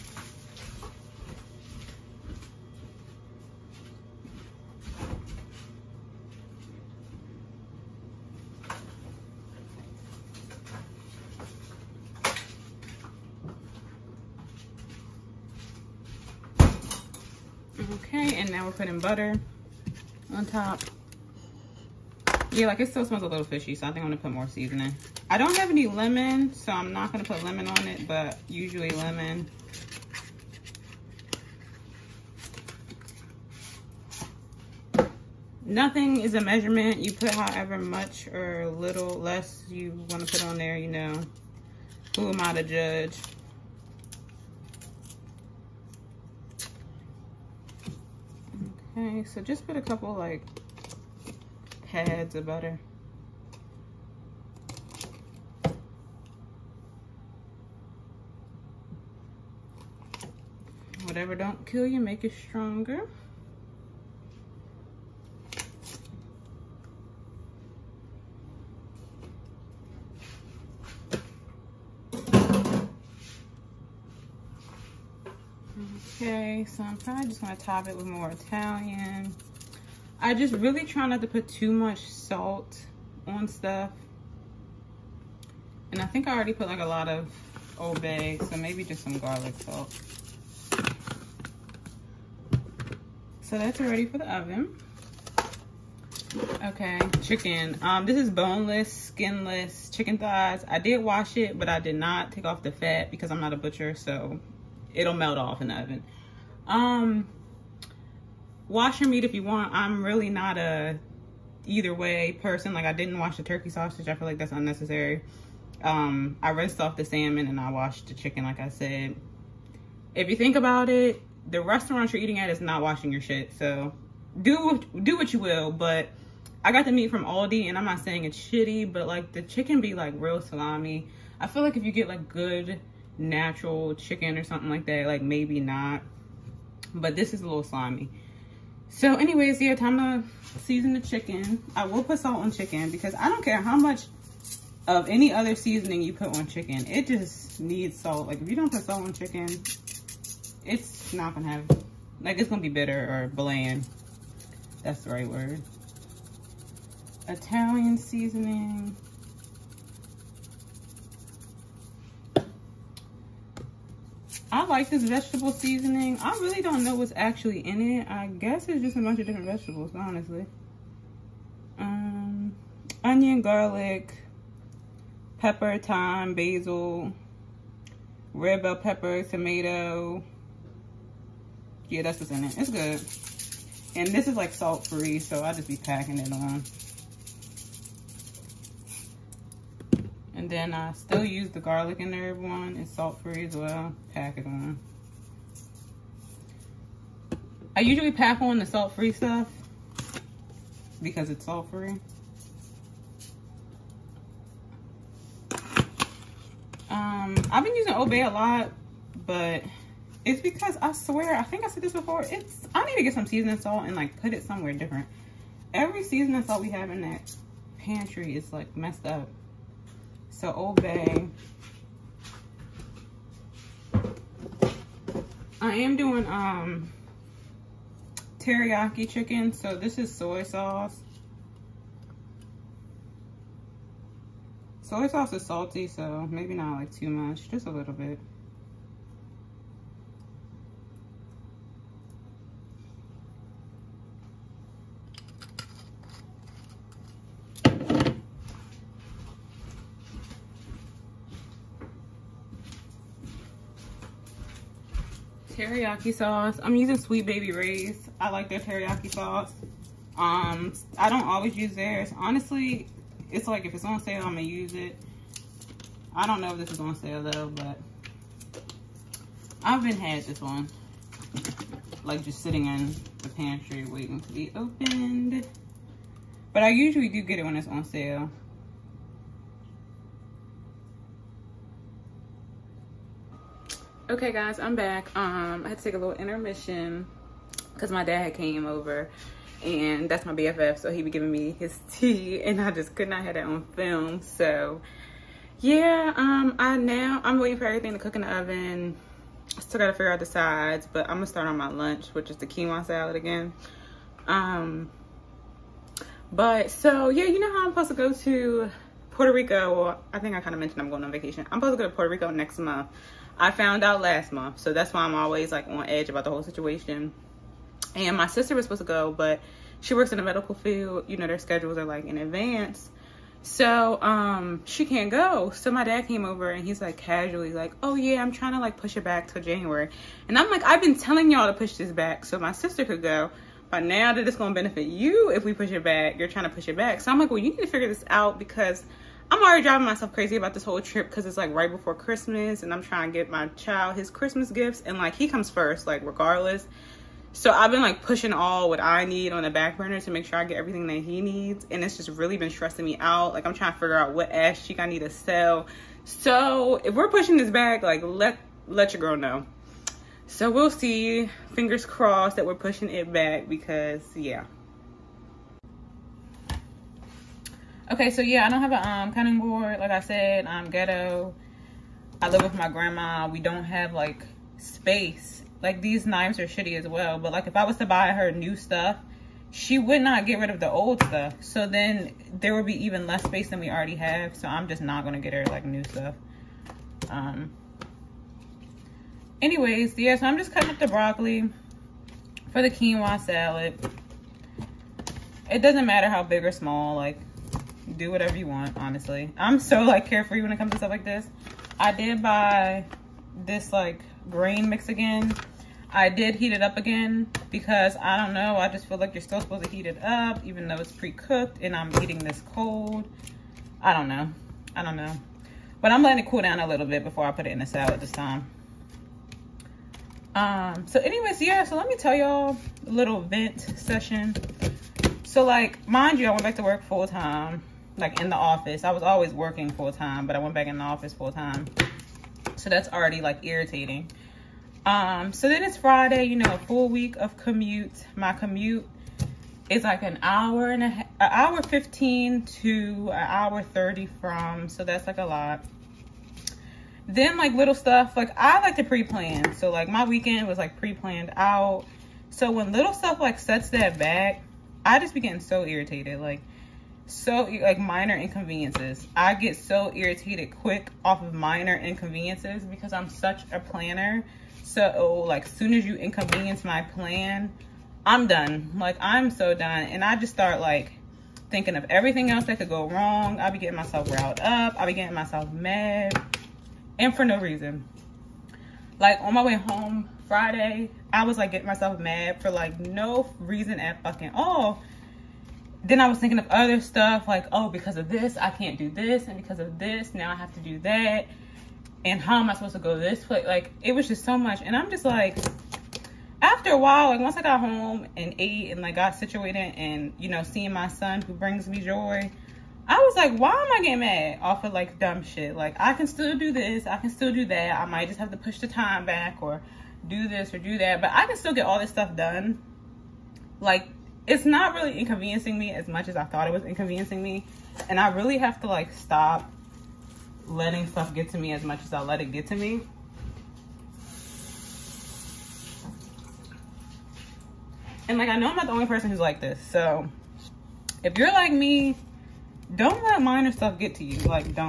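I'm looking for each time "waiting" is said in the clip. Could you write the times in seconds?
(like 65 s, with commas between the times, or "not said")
273 s, 297 s.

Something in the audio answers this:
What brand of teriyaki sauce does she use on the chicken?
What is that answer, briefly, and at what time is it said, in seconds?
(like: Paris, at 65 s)
Sweet Baby Ray's, at 256 s.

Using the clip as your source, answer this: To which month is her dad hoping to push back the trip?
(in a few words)
January.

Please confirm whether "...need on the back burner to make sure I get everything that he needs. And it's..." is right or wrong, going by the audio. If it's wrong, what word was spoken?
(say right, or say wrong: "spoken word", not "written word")
right.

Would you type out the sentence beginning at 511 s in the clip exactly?
But I can still get all this stuff done.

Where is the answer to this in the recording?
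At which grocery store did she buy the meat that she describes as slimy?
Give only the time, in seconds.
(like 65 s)
127 s.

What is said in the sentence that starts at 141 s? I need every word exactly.
I will put salt on chicken because I don't care how much of any other seasoning you put on chicken.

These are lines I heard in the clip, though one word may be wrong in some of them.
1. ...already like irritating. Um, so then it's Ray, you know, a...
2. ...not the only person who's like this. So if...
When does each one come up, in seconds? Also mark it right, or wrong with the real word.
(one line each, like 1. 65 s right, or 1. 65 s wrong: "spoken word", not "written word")
1. 432 s wrong: "Friday", not "Ray"
2. 528 s right.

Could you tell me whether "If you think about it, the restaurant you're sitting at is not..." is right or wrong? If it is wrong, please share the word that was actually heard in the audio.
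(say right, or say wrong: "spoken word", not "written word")
wrong: "eating", not "sitting".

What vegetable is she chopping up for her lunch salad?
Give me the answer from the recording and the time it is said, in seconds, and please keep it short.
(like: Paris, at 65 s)
broccoli, at 390 s.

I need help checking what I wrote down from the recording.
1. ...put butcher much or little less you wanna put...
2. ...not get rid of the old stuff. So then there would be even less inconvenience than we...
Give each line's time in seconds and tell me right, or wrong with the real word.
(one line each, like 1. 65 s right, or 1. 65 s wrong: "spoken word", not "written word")
1. 37 s wrong: "however", not "butcher"
2. 380 s wrong: "space", not "inconvenience".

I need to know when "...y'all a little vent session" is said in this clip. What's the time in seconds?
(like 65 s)
422 s.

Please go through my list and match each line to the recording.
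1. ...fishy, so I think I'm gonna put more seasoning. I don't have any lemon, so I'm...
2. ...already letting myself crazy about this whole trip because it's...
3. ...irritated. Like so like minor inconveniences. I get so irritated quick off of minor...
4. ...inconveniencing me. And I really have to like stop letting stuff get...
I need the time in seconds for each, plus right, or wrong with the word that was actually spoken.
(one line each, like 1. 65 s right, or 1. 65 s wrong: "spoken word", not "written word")
1. 23 s right
2. 339 s wrong: "driving", not "letting"
3. 455 s right
4. 516 s right.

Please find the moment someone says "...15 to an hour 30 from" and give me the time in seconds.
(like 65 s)
441 s.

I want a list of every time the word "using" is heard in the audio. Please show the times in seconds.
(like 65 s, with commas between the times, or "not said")
207 s, 256 s.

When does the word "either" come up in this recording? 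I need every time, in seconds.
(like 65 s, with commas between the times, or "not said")
111 s.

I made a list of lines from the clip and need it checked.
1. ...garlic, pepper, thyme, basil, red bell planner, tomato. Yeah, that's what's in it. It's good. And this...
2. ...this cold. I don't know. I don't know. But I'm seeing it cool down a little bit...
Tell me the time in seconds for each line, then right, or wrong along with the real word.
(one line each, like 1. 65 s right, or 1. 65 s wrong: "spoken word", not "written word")
1. 173 s wrong: "pepper", not "planner"
2. 412 s wrong: "letting", not "seeing".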